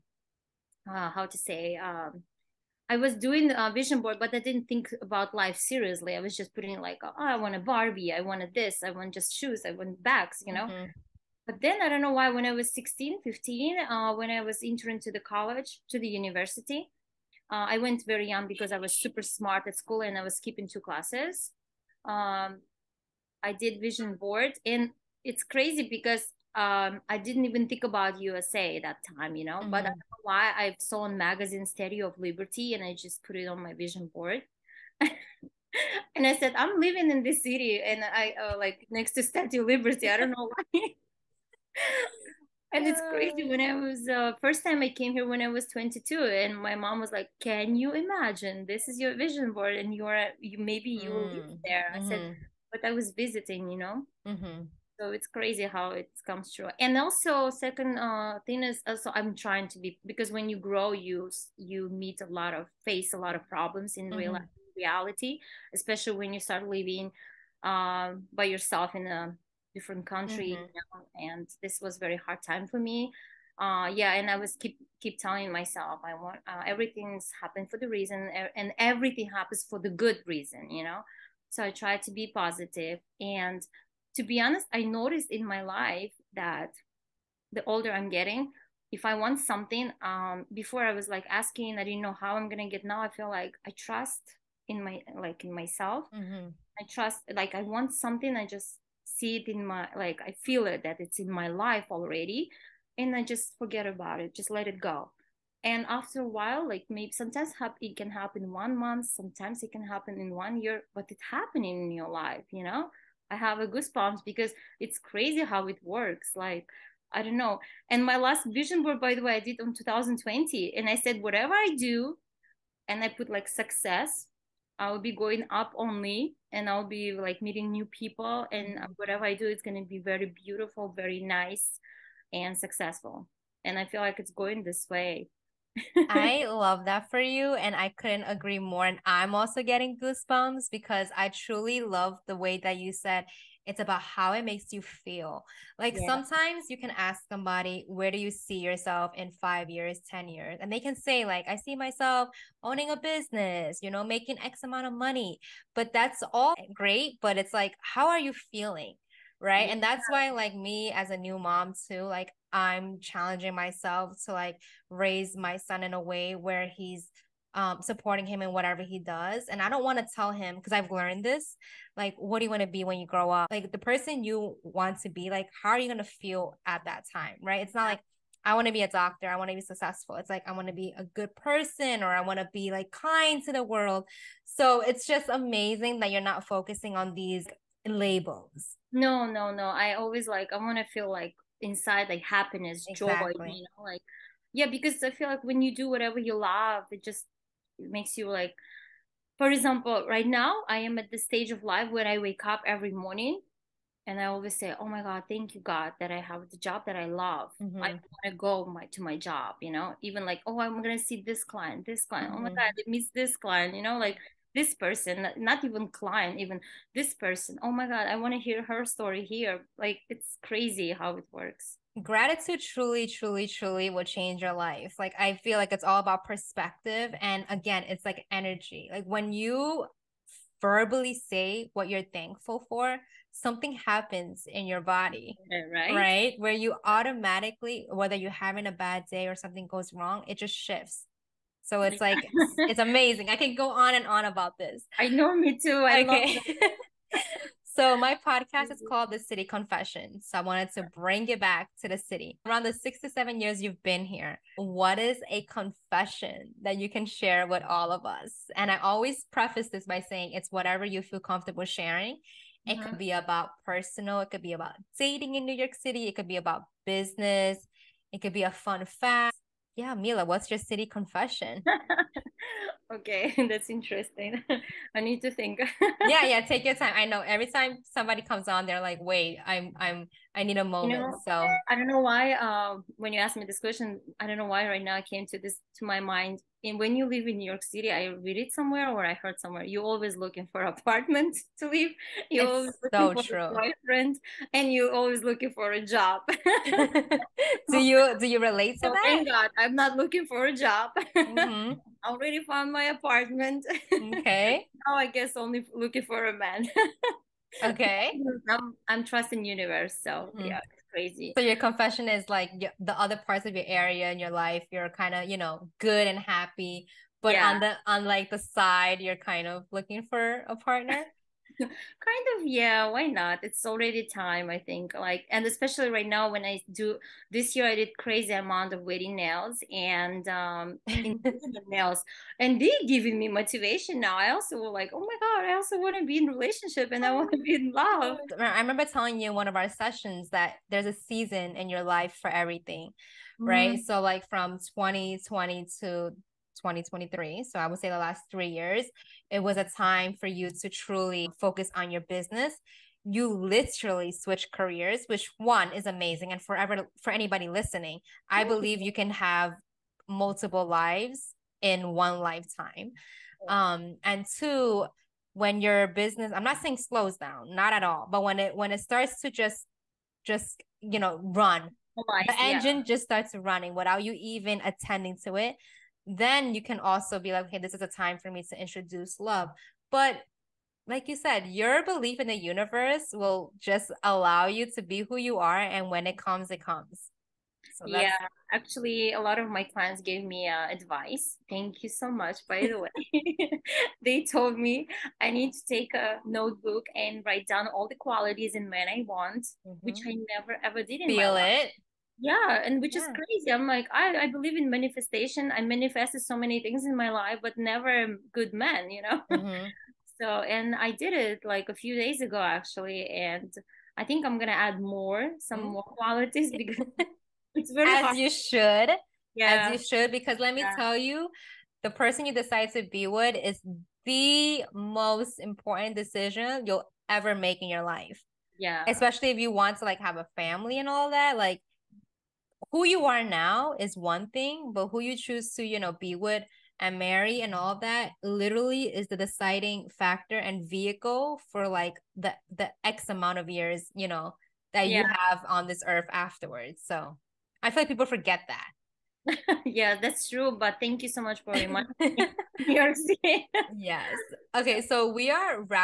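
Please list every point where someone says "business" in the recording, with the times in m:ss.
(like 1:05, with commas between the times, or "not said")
2:32, 4:26, 5:52, 6:05.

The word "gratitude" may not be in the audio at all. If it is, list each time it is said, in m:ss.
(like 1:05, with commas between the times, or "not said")
3:42.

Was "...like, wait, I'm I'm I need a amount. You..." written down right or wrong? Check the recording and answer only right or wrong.
wrong.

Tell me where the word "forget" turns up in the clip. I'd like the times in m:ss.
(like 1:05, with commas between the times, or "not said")
1:43, 7:28.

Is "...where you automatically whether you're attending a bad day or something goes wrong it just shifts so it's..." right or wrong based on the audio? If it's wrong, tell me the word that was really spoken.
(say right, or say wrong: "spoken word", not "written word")
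wrong: "having", not "attending".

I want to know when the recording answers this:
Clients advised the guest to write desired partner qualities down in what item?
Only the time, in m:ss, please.
6:36.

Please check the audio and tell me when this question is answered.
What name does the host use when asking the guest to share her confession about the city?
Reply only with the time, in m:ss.
4:29.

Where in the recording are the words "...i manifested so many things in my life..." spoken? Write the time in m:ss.
6:45.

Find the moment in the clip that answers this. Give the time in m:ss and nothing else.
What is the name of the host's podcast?
4:09.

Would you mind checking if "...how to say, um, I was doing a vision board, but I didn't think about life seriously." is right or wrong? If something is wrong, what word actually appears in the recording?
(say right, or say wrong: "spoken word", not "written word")
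right.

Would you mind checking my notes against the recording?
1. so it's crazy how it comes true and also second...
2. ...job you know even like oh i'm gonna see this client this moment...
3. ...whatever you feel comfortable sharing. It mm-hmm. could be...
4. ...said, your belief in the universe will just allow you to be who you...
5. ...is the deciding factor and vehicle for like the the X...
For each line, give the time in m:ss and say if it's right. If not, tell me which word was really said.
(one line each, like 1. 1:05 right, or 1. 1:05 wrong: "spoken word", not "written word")
1. 0:54 right
2. 3:29 wrong: "client", not "moment"
3. 4:20 right
4. 6:21 right
5. 7:18 right.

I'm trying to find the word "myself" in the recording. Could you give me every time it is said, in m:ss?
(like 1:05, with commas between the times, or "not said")
1:15, 1:35, 2:31, 2:43.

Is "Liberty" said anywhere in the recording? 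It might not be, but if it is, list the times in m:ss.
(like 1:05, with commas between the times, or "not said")
0:32, 0:39.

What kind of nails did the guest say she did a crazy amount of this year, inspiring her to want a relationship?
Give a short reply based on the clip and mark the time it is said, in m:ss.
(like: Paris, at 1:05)
wedding nails, at 5:28.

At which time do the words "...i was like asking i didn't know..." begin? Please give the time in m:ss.
1:30.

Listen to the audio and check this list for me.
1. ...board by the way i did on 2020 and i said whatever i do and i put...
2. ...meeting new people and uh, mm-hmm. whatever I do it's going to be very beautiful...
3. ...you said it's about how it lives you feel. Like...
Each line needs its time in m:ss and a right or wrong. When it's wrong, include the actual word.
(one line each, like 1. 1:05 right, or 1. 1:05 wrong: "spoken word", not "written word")
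1. 1:58 right
2. 2:07 right
3. 2:22 wrong: "makes", not "lives".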